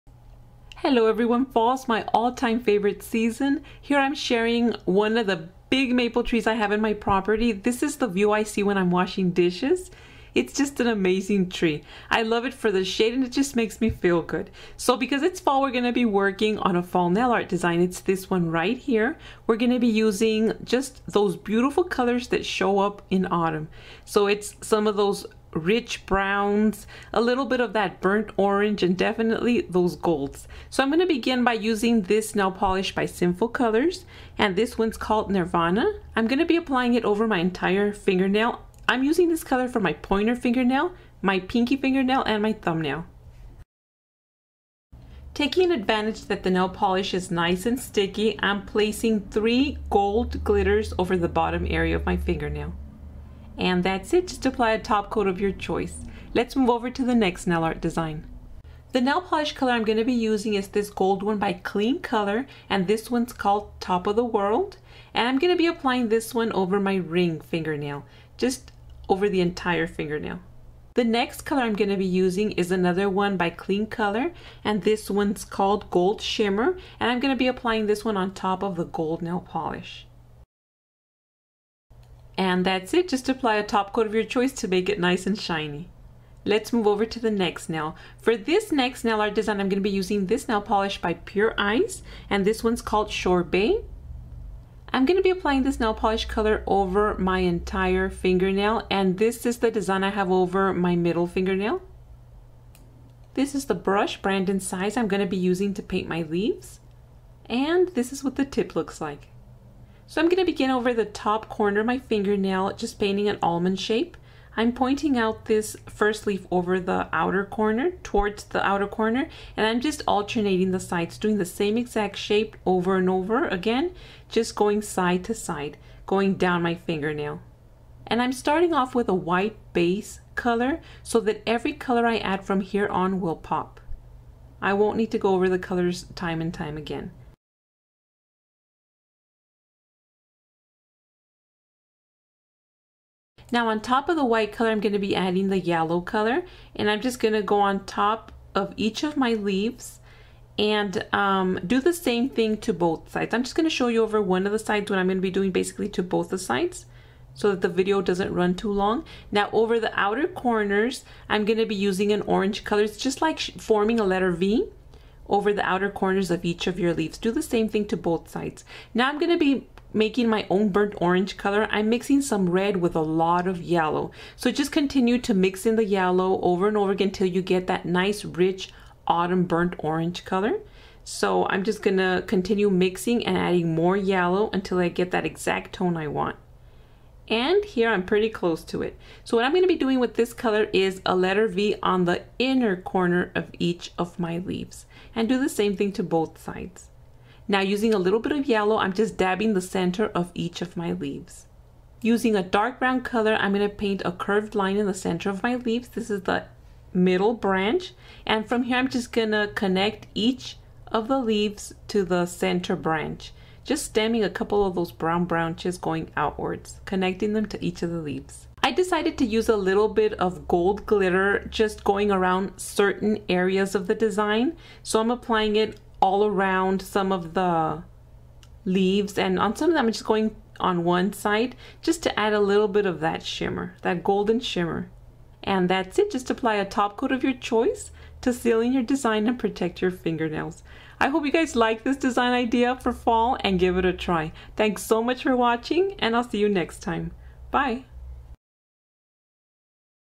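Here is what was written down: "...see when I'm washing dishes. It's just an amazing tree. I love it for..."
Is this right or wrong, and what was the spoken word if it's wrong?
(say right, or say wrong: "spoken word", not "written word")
right.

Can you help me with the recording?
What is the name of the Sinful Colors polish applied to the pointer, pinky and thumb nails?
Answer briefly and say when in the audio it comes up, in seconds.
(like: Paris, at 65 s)
Nirvana, at 35 s.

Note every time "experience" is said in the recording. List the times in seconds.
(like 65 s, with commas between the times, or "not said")
not said.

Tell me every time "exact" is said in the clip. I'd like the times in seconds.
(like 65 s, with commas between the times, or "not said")
121 s, 185 s.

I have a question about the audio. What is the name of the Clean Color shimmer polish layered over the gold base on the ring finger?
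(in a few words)
Gold Shimmer.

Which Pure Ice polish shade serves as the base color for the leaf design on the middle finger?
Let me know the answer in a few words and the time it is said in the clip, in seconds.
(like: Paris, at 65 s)
Shore Bay, at 93 s.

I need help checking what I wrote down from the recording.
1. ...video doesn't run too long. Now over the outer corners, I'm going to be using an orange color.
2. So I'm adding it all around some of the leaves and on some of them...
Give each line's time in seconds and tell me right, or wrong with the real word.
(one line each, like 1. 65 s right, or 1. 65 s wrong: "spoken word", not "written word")
1. 157 s right
2. 224 s wrong: "applying", not "adding".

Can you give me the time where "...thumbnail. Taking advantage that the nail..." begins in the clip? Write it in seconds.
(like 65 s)
42 s.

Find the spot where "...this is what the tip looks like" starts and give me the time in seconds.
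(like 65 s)
107 s.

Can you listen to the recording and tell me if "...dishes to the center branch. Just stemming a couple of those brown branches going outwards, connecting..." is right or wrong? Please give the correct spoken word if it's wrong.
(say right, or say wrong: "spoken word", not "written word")
wrong: "leaves", not "dishes".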